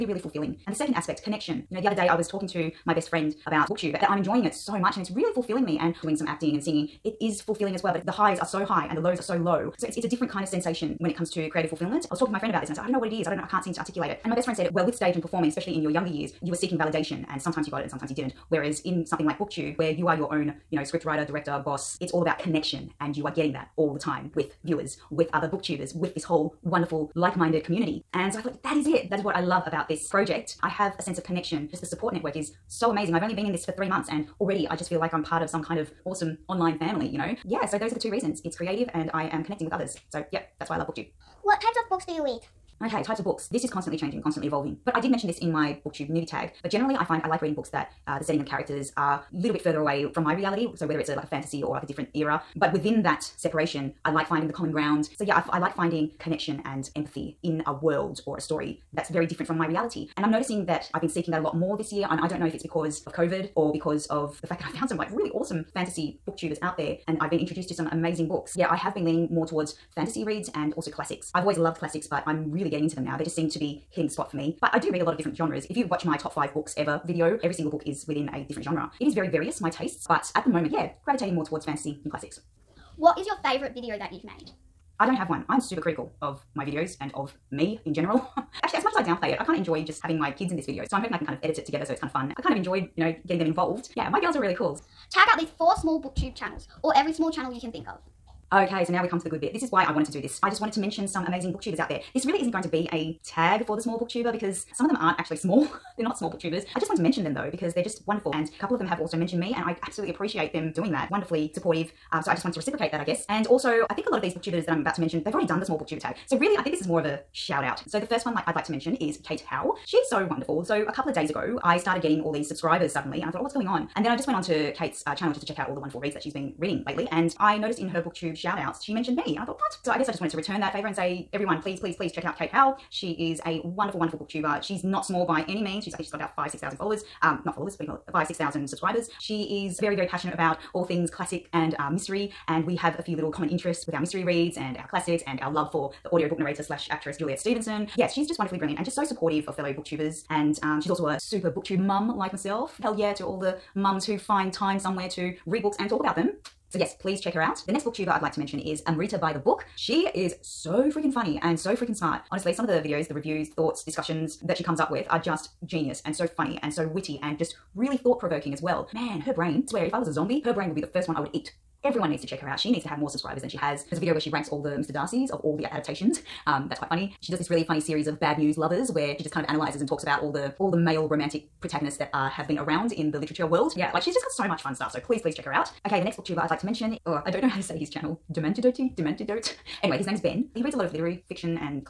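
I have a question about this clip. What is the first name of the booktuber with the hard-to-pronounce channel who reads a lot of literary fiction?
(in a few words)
Ben.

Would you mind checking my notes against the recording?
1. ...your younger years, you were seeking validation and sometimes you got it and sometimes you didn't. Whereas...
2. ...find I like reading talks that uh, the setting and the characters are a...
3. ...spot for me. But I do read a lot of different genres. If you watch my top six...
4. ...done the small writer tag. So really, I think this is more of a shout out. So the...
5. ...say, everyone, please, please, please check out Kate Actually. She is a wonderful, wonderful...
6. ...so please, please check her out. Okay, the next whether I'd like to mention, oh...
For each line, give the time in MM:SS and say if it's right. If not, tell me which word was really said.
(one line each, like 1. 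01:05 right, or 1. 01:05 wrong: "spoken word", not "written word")
1. 00:15 right
2. 00:47 wrong: "books", not "talks"
3. 01:14 wrong: "five", not "six"
4. 01:55 wrong: "booktuber", not "writer"
5. 02:10 wrong: "Howe", not "Actually"
6. 03:04 wrong: "booktuber", not "whether".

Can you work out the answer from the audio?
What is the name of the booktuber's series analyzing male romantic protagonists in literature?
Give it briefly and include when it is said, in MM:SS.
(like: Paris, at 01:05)
Bad News Lovers, at 02:58.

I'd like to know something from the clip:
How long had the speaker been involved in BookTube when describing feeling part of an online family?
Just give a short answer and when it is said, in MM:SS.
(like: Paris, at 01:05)
3 months, at 00:33.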